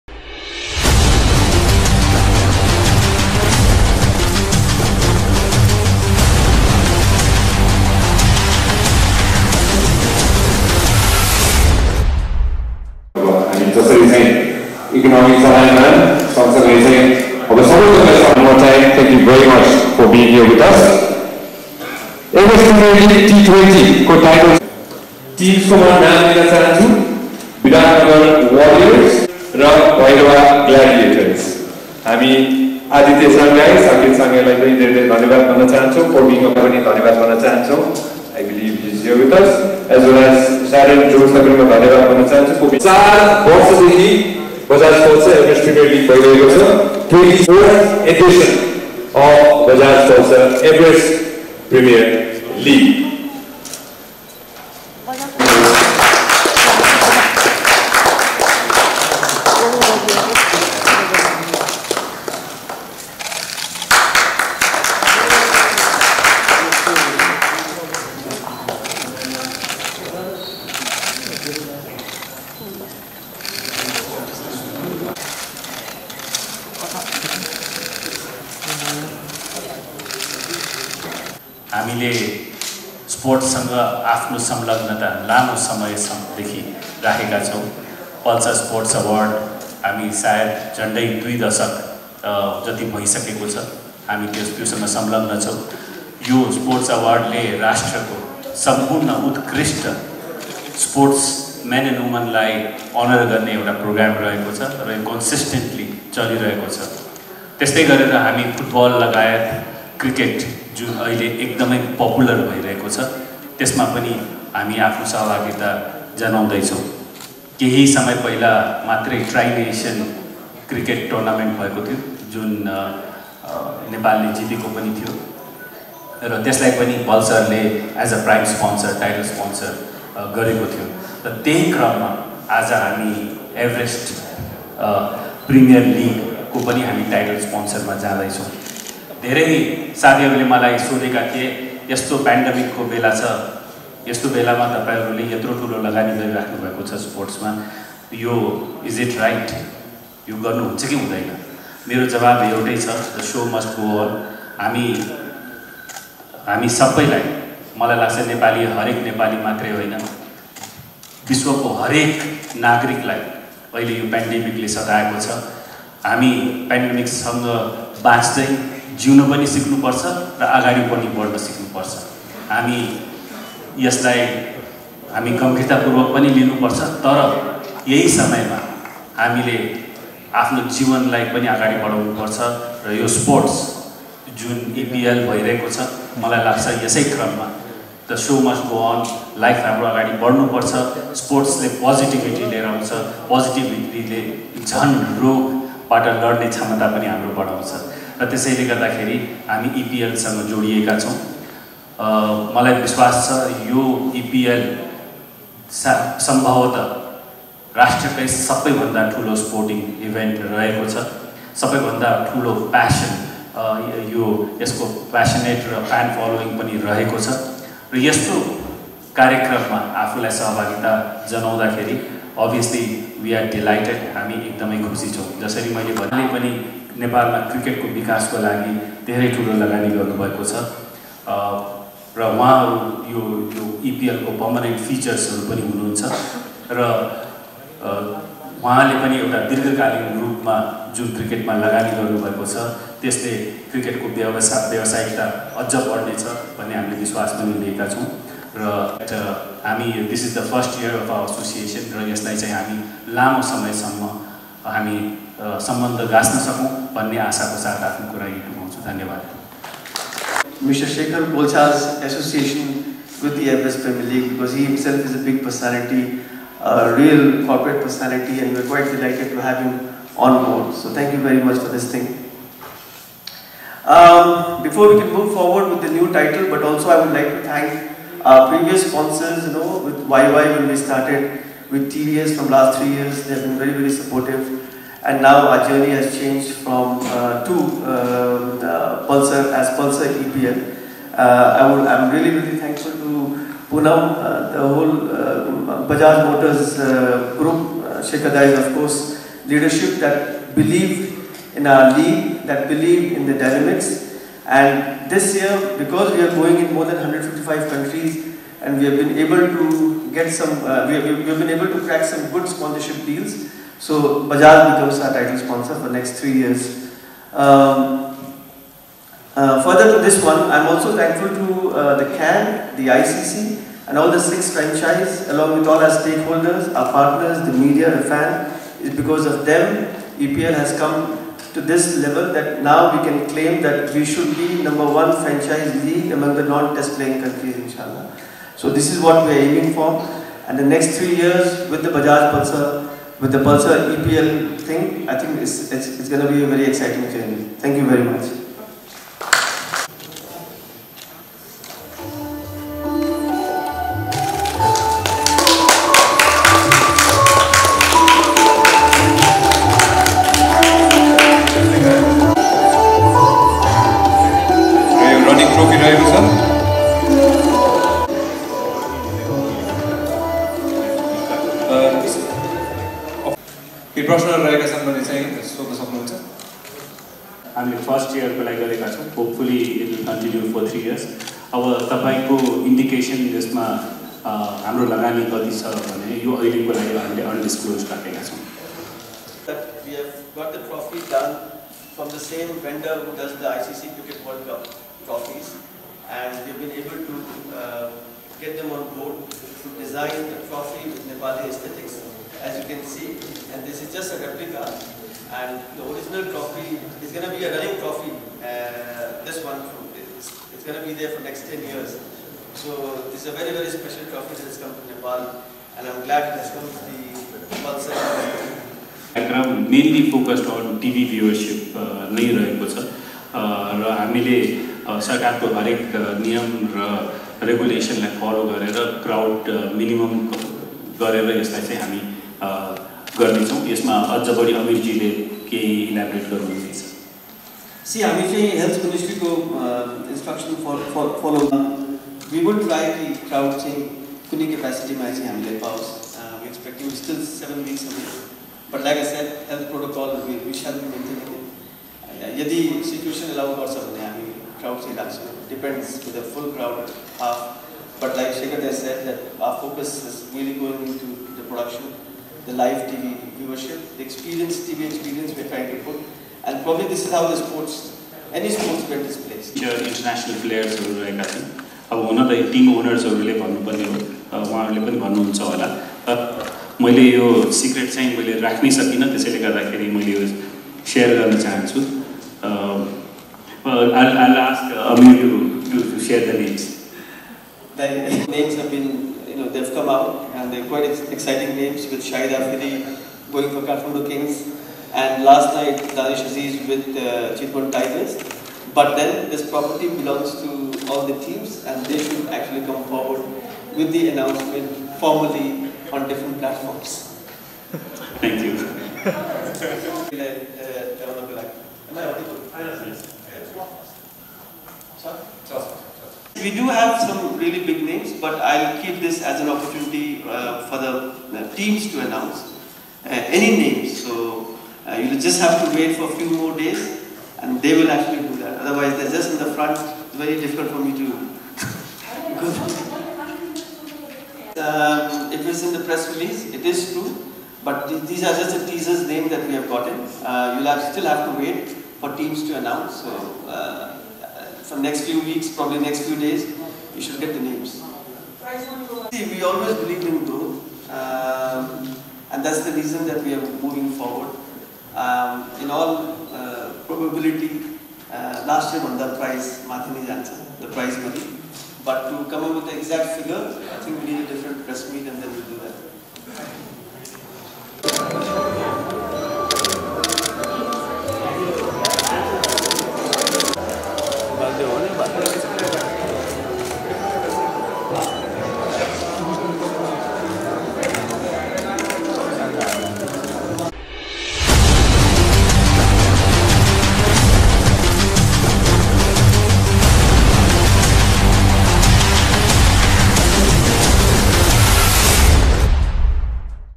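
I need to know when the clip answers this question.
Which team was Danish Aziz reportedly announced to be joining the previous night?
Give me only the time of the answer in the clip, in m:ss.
8:17.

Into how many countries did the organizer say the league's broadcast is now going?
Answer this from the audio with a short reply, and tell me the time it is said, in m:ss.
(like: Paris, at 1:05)
155, at 5:06.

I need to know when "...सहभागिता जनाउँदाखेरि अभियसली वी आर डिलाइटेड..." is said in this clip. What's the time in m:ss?
3:40.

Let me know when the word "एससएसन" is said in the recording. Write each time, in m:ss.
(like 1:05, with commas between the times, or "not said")
4:11.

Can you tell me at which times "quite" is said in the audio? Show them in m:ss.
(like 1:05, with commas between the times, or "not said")
4:28, 8:10.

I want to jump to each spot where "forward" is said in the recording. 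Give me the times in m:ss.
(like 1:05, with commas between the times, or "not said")
4:35, 8:22, 9:13.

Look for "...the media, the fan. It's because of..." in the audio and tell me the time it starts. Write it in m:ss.
5:27.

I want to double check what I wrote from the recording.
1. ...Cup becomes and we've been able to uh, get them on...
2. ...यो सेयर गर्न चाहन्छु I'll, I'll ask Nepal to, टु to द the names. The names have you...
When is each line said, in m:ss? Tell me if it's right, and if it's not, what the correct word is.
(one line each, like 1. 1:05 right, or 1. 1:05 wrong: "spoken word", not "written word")
1. 6:34 wrong: "trophies", not "becomes"
2. 8:00 wrong: "Amir", not "Nepal".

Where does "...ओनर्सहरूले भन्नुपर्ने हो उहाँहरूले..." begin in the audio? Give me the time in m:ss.
7:52.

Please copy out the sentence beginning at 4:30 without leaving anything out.
So thank you very much for this thing.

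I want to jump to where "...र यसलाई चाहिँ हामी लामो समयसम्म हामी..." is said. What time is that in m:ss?
4:11.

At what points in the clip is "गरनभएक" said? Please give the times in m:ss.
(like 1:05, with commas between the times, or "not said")
3:49, 4:01.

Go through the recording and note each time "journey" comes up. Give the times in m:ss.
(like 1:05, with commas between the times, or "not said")
4:45, 5:47.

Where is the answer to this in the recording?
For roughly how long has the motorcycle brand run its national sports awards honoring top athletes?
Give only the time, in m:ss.
1:31.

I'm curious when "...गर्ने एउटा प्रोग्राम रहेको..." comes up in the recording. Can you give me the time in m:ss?
1:43.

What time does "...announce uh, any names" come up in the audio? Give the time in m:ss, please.
8:42.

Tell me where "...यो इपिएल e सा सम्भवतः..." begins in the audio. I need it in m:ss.
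3:23.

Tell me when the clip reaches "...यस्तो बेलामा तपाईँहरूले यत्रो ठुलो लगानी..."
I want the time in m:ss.
2:24.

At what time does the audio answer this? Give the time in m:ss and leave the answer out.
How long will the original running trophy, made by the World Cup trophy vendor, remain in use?
6:51.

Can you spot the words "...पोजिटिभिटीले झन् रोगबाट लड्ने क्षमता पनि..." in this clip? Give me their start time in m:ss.
3:13.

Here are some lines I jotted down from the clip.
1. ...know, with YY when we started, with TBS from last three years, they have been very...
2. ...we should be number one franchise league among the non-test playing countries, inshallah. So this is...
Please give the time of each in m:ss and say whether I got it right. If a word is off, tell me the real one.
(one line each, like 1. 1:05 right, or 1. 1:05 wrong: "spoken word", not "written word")
1. 4:39 right
2. 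5:33 right.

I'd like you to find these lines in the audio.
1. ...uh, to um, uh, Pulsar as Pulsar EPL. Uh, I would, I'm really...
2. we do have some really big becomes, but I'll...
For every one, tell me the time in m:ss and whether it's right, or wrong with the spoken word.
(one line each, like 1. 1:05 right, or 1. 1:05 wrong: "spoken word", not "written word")
1. 4:47 right
2. 8:36 wrong: "names", not "becomes".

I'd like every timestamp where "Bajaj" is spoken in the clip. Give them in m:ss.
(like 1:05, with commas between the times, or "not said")
0:49, 4:55, 5:14, 5:41.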